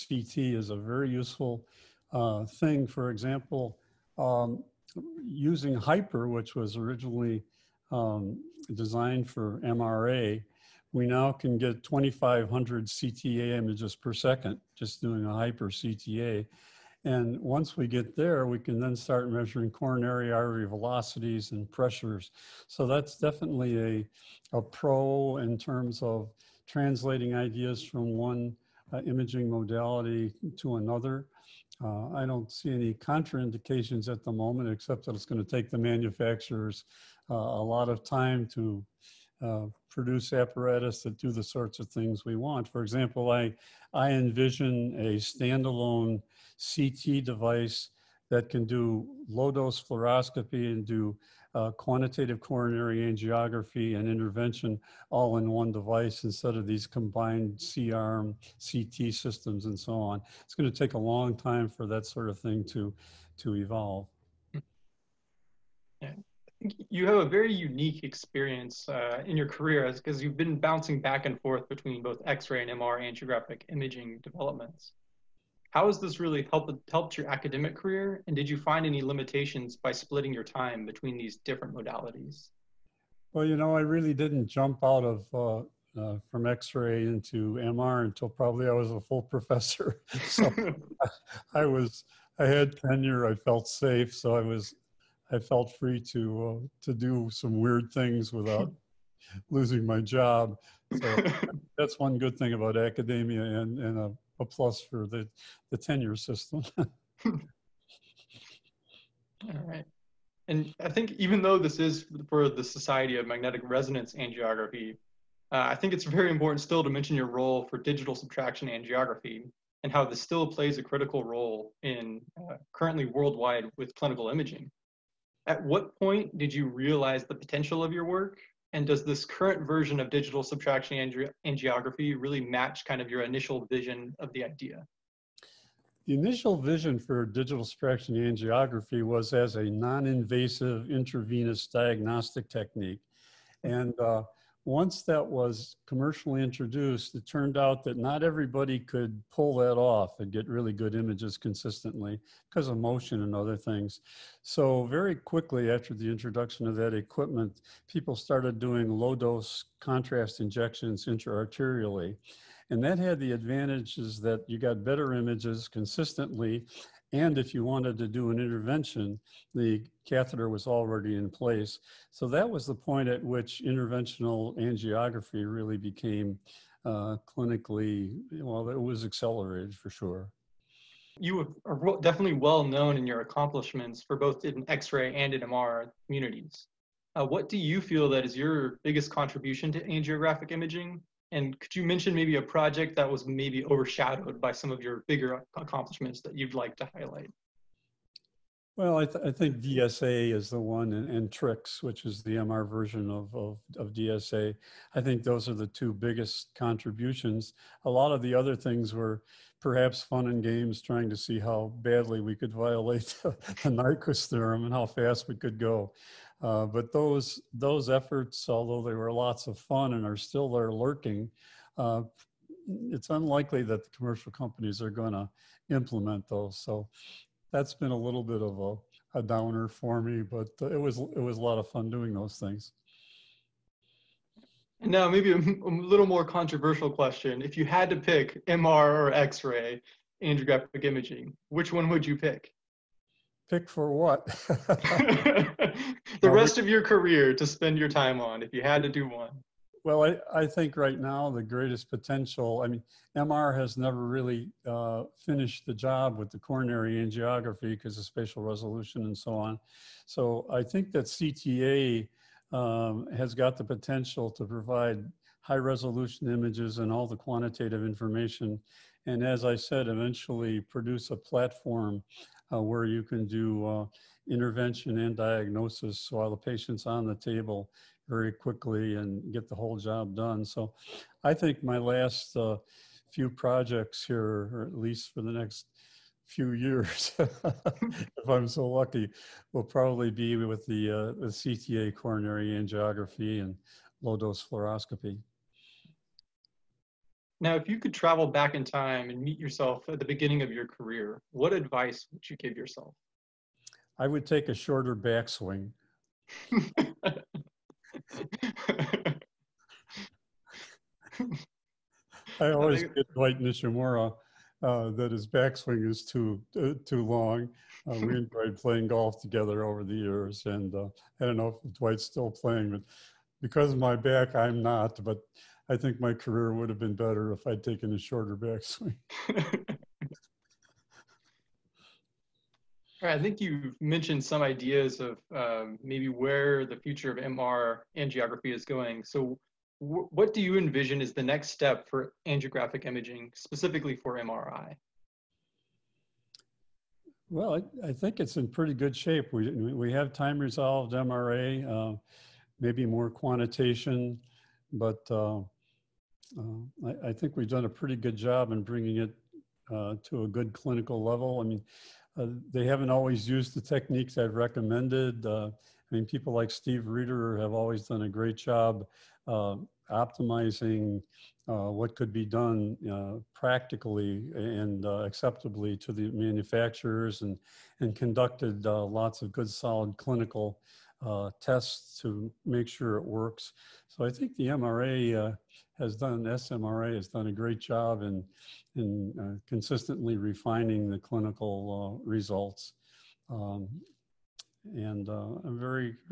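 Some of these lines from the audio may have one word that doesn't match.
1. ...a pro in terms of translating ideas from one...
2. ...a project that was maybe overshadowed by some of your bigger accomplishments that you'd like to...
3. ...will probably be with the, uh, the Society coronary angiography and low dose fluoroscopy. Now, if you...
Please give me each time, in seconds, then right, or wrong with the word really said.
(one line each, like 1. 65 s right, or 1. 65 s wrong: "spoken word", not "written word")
1. 24 s right
2. 192 s right
3. 289 s wrong: "CTA", not "Society".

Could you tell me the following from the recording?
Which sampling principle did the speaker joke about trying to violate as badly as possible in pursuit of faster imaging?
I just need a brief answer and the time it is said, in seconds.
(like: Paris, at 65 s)
Nyquist theorem, at 213 s.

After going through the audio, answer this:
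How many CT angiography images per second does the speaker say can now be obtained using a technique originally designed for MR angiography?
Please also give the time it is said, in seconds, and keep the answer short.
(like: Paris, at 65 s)
2,500, at 11 s.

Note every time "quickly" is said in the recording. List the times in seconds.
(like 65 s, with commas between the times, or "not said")
155 s, 278 s.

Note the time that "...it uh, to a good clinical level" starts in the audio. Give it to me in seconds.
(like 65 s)
358 s.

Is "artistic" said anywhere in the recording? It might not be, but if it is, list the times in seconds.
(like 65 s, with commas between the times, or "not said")
not said.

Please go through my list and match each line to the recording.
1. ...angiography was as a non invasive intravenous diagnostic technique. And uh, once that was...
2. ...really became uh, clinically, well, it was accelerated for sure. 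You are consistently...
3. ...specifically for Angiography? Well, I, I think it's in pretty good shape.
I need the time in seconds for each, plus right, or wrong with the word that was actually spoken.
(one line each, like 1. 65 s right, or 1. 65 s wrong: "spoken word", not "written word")
1. 138 s right
2. 175 s wrong: "definitely", not "consistently"
3. 343 s wrong: "MRI", not "Angiography".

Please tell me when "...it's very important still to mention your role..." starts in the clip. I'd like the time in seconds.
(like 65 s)
115 s.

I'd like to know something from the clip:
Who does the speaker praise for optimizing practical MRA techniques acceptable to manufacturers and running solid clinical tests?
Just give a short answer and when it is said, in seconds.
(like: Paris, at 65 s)
Steve Reeder, at 366 s.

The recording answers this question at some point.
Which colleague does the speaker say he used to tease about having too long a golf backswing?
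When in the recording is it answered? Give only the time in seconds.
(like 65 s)
313 s.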